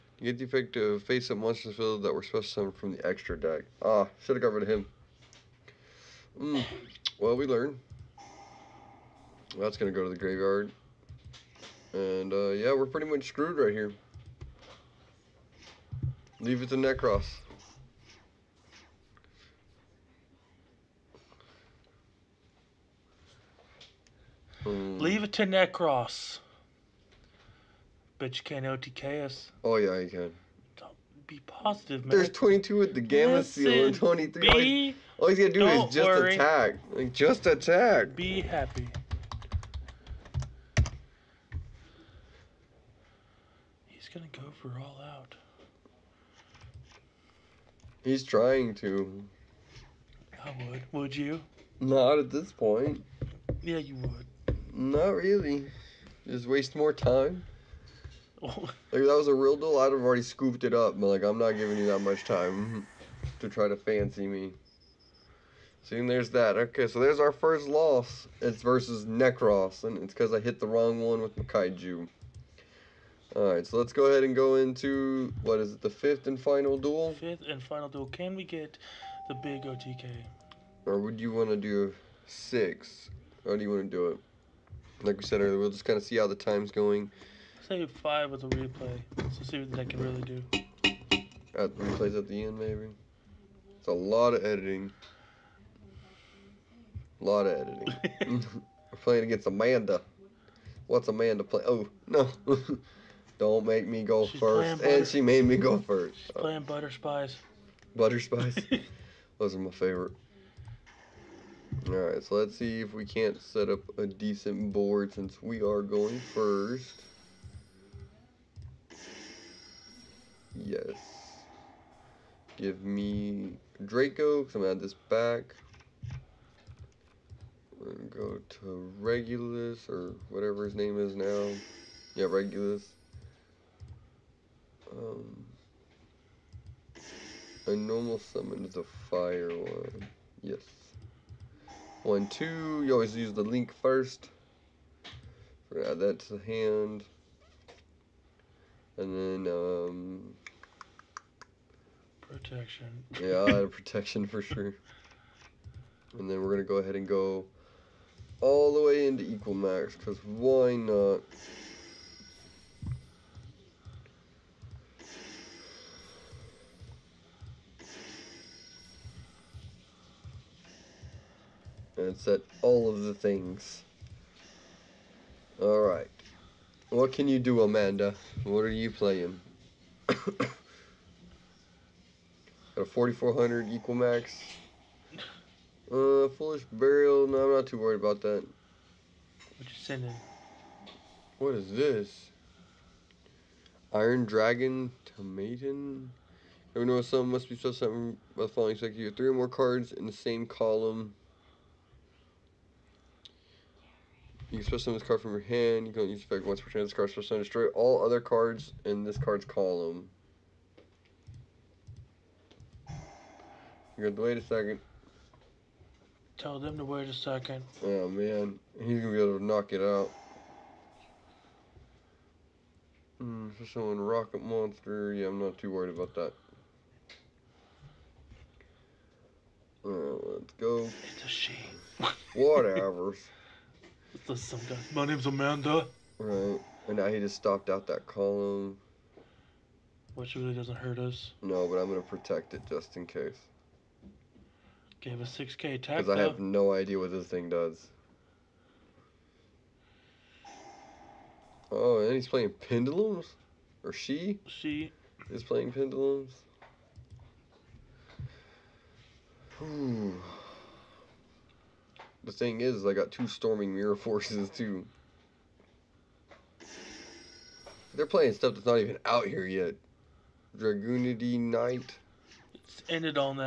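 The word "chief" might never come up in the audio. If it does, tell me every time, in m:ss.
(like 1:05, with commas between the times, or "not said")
not said.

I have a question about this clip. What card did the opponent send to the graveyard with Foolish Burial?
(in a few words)
Iron Dragon Tiamaton.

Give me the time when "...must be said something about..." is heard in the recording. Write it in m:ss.
3:17.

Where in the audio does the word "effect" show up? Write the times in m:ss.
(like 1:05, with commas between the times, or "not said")
0:00, 3:26.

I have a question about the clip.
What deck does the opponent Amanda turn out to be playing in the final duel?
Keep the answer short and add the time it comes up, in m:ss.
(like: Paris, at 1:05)
Butter spies, at 1:46.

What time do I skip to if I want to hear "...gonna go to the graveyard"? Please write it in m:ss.
0:09.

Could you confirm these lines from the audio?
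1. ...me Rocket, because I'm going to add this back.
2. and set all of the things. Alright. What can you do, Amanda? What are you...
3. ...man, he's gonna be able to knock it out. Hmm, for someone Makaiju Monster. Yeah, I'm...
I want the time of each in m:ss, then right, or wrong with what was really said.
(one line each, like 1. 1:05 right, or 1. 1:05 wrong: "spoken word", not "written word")
1. 2:02 wrong: "Draco", not "Rocket"
2. 2:51 right
3. 3:38 wrong: "Rocket", not "Makaiju".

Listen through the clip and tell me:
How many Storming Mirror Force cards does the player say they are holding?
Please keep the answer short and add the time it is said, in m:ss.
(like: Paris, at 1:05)
2, at 4:22.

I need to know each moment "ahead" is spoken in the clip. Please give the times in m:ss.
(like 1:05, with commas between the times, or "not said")
1:14, 2:36.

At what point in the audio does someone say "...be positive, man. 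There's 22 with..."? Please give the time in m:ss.
0:31.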